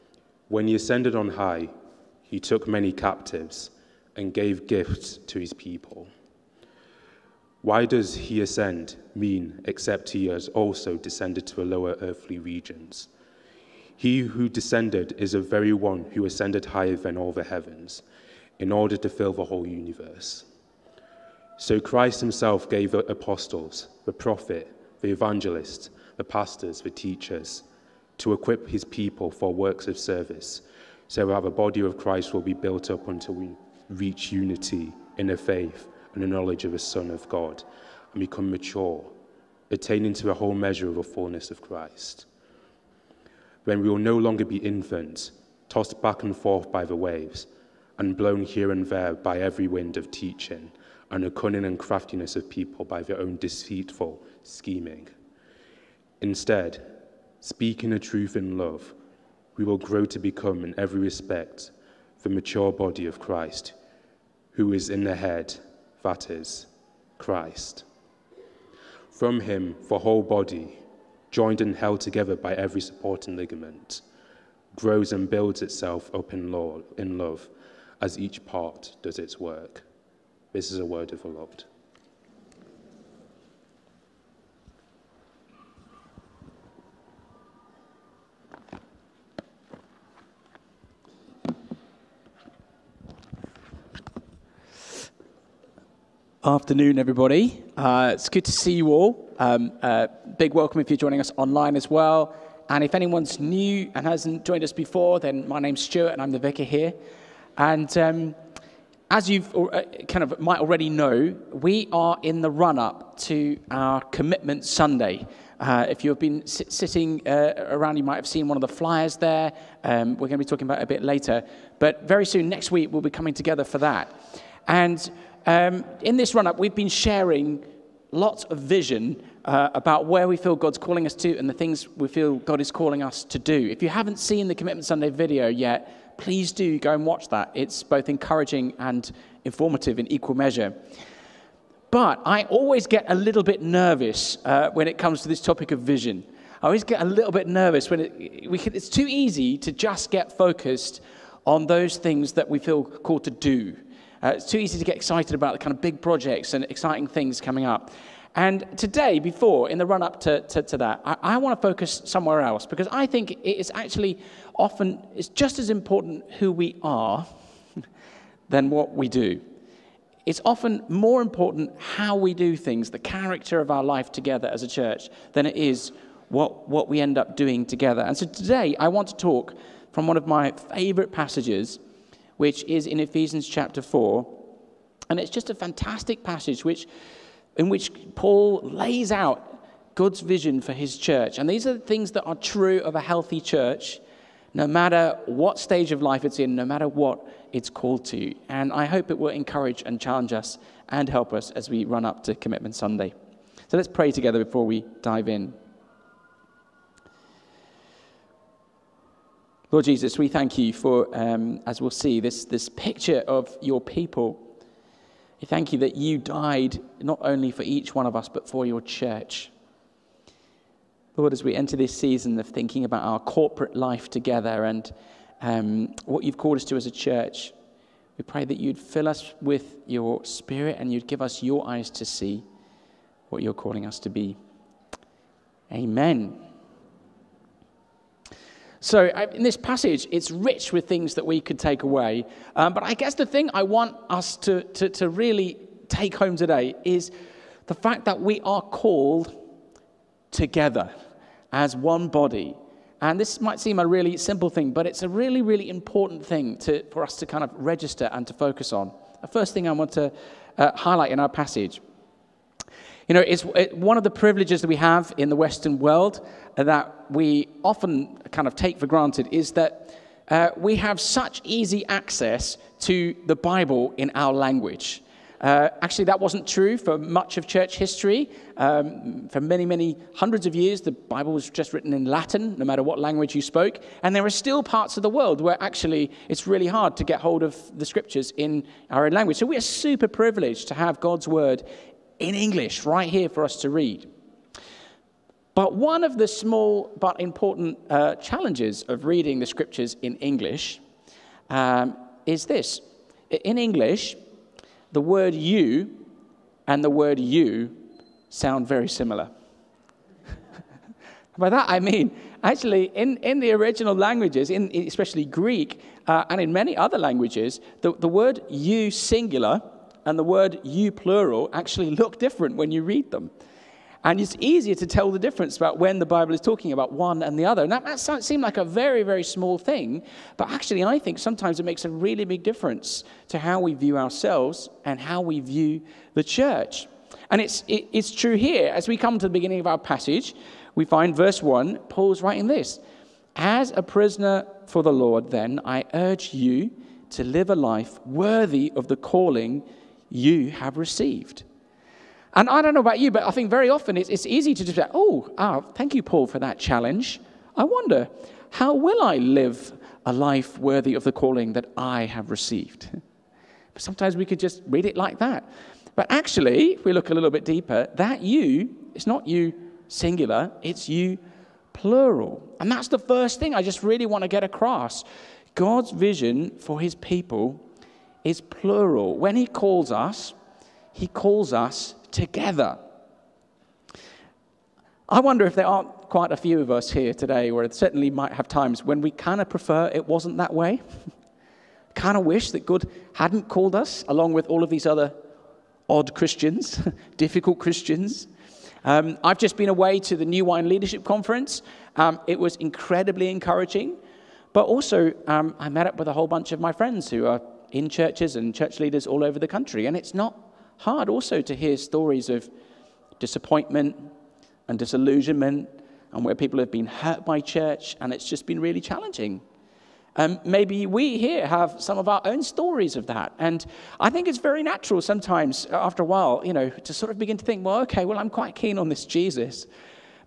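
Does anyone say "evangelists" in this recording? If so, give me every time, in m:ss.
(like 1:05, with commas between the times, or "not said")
0:25.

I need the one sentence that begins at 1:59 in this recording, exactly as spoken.
Um, we're going to be talking about it a bit later.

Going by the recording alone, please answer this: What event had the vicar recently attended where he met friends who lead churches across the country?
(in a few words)
New Wine Leadership Conference.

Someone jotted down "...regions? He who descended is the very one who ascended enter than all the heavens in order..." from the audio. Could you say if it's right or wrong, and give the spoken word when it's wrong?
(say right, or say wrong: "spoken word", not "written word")
wrong: "higher", not "enter".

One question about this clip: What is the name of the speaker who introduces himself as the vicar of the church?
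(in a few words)
Stuart.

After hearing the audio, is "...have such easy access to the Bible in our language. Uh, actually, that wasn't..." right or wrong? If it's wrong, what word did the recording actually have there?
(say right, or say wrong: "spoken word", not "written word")
right.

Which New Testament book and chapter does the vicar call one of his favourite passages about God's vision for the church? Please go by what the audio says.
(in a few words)
Ephesians chapter 4.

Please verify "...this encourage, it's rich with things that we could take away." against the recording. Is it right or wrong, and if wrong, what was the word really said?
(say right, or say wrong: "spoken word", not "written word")
wrong: "passage", not "encourage".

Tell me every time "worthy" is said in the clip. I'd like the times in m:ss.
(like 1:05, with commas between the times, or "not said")
5:48, 6:00.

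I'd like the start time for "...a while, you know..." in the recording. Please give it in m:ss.
7:06.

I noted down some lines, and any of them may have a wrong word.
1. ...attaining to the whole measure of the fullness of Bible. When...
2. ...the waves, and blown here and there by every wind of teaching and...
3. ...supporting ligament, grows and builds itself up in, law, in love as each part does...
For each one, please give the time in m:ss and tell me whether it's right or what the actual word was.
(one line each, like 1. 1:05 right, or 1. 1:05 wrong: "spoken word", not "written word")
1. 0:39 wrong: "Christ", not "Bible"
2. 0:46 right
3. 1:12 right.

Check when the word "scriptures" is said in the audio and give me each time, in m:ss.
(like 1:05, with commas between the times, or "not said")
4:47, 4:59.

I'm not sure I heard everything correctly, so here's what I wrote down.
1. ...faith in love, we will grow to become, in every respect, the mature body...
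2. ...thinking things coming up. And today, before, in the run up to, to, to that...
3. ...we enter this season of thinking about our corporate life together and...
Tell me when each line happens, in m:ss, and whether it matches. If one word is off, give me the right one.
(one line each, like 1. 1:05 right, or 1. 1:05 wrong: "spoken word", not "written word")
1. 0:57 wrong: "truth", not "faith"
2. 2:36 wrong: "exciting", not "thinking"
3. 3:41 right.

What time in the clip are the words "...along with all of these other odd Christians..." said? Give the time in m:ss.
6:34.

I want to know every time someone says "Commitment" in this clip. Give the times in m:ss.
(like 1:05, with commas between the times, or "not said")
1:54, 2:14, 3:22.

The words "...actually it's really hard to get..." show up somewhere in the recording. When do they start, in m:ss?
4:45.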